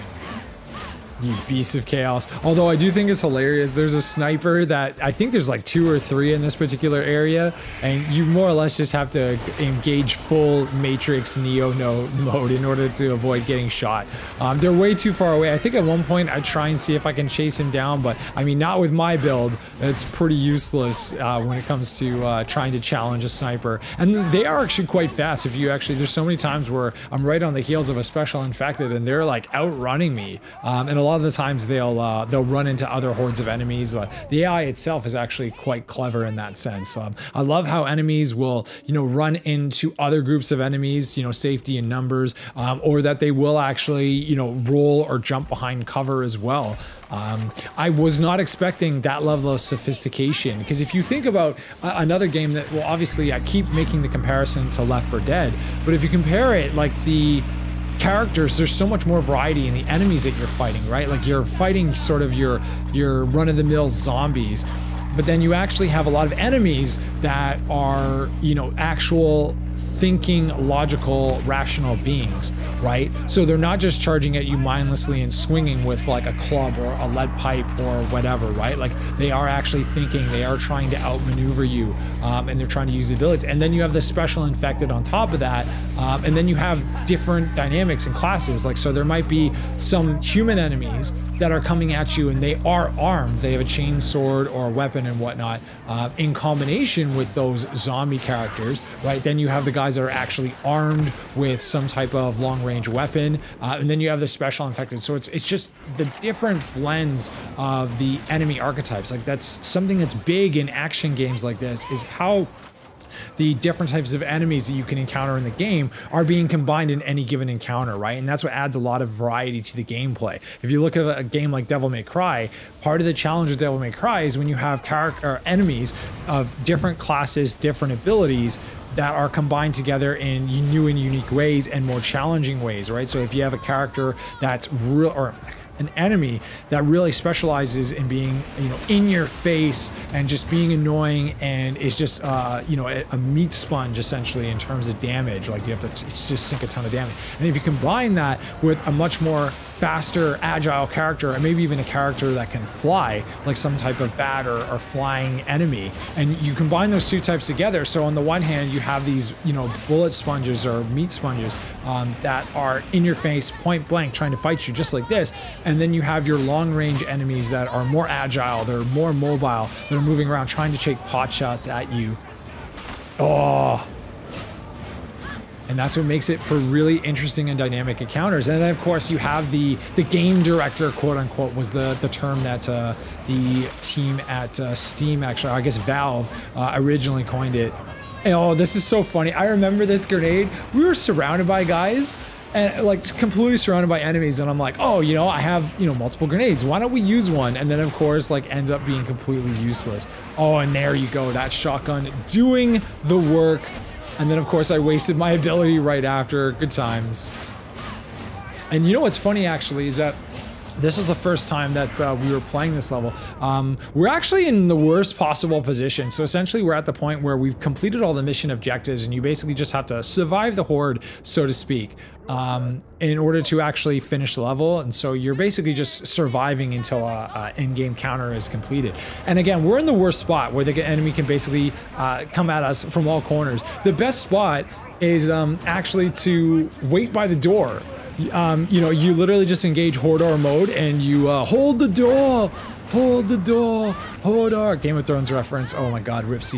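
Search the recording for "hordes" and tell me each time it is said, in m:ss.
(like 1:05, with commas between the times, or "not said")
0:33, 3:40.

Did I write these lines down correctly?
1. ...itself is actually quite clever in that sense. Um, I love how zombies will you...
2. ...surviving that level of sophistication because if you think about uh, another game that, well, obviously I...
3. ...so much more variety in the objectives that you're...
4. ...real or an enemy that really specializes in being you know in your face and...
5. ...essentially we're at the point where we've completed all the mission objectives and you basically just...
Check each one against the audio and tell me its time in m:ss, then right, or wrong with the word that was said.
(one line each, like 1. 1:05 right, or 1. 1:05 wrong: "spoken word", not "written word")
1. 0:34 wrong: "enemies", not "zombies"
2. 0:48 wrong: "expecting", not "surviving"
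3. 0:58 wrong: "enemies", not "objectives"
4. 2:14 right
5. 3:36 right.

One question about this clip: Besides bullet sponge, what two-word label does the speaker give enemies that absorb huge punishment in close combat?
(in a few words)
meat sponge.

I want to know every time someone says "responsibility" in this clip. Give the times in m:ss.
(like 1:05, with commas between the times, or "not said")
not said.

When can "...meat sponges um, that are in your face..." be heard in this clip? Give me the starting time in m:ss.
2:40.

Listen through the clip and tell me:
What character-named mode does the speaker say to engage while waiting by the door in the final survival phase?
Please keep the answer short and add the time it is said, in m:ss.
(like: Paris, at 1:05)
Hodor mode, at 3:59.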